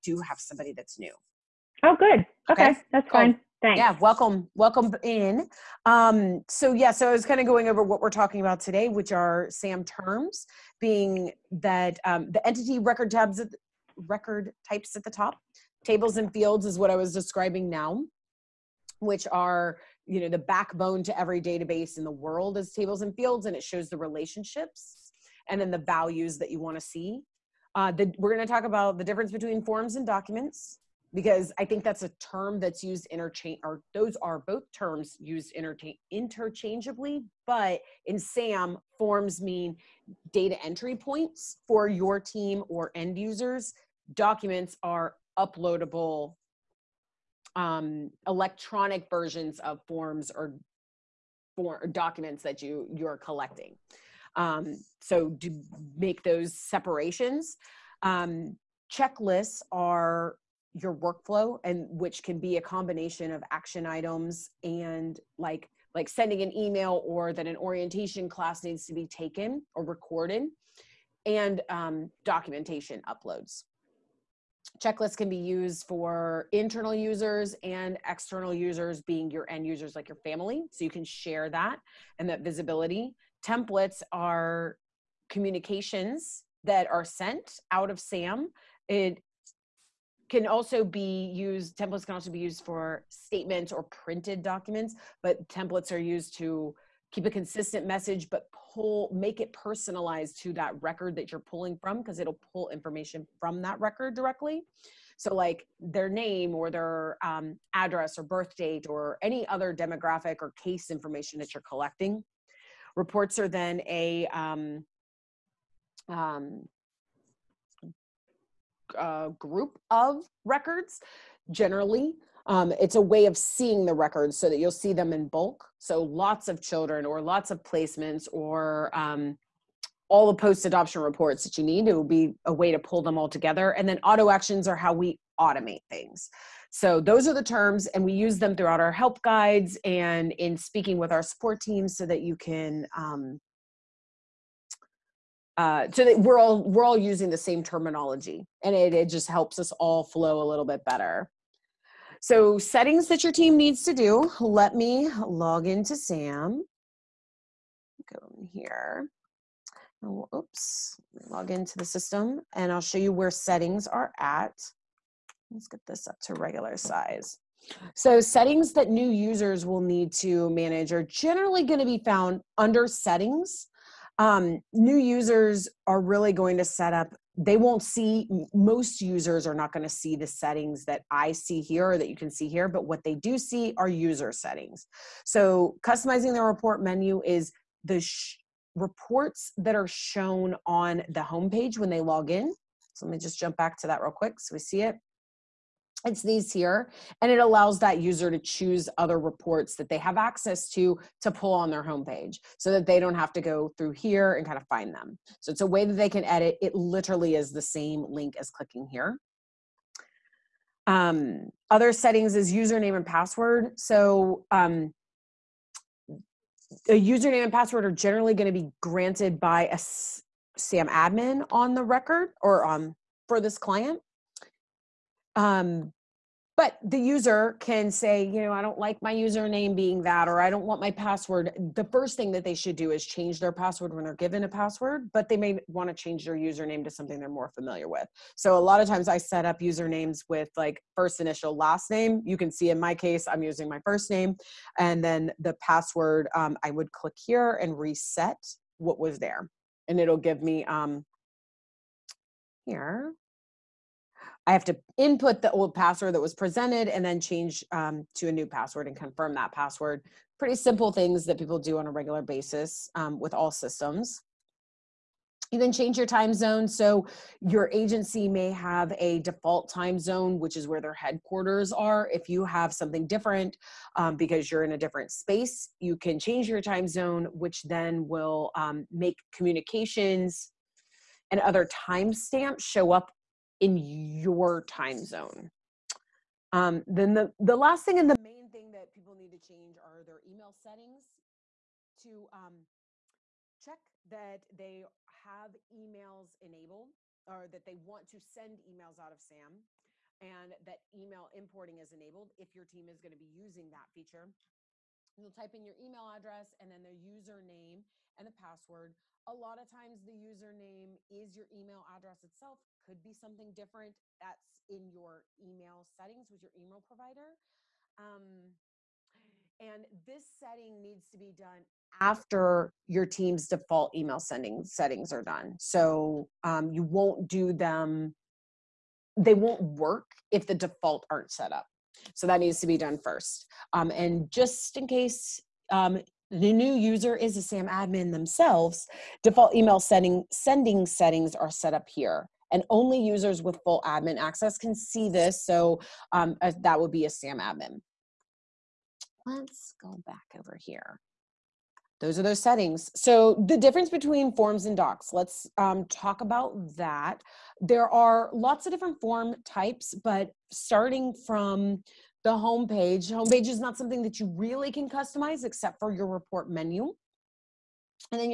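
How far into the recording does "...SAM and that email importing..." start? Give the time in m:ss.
4:59.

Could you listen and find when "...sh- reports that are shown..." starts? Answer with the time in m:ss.
3:08.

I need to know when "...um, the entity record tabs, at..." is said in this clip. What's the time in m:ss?
0:12.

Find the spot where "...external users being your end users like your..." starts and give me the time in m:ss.
1:18.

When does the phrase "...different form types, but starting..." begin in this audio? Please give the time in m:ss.
5:58.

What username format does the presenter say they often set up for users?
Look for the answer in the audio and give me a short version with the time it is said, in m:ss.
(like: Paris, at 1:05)
First initial, last name, at 4:00.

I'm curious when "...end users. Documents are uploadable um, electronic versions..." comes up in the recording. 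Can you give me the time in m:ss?
0:42.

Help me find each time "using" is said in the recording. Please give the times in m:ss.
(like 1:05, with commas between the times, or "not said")
2:26, 4:03, 5:03.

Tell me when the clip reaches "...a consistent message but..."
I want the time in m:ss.
1:37.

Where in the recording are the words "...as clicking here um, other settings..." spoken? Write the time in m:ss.
3:28.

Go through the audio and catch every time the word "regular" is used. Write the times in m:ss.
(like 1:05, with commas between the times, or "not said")
2:46, 4:21.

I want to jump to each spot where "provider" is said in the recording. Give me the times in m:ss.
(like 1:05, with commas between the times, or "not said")
5:16.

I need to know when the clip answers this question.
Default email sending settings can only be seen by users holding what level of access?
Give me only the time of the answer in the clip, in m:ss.
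5:43.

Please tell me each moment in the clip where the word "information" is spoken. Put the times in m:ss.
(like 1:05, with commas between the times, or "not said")
1:42, 1:50.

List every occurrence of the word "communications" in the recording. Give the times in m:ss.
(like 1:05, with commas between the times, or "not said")
1:25, 4:39.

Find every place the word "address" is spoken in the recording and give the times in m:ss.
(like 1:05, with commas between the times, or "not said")
1:47, 5:06, 5:11.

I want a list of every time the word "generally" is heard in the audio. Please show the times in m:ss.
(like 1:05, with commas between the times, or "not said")
2:01, 2:51, 3:37.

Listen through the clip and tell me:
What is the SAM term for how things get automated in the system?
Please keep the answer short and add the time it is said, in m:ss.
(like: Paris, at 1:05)
Auto actions, at 2:14.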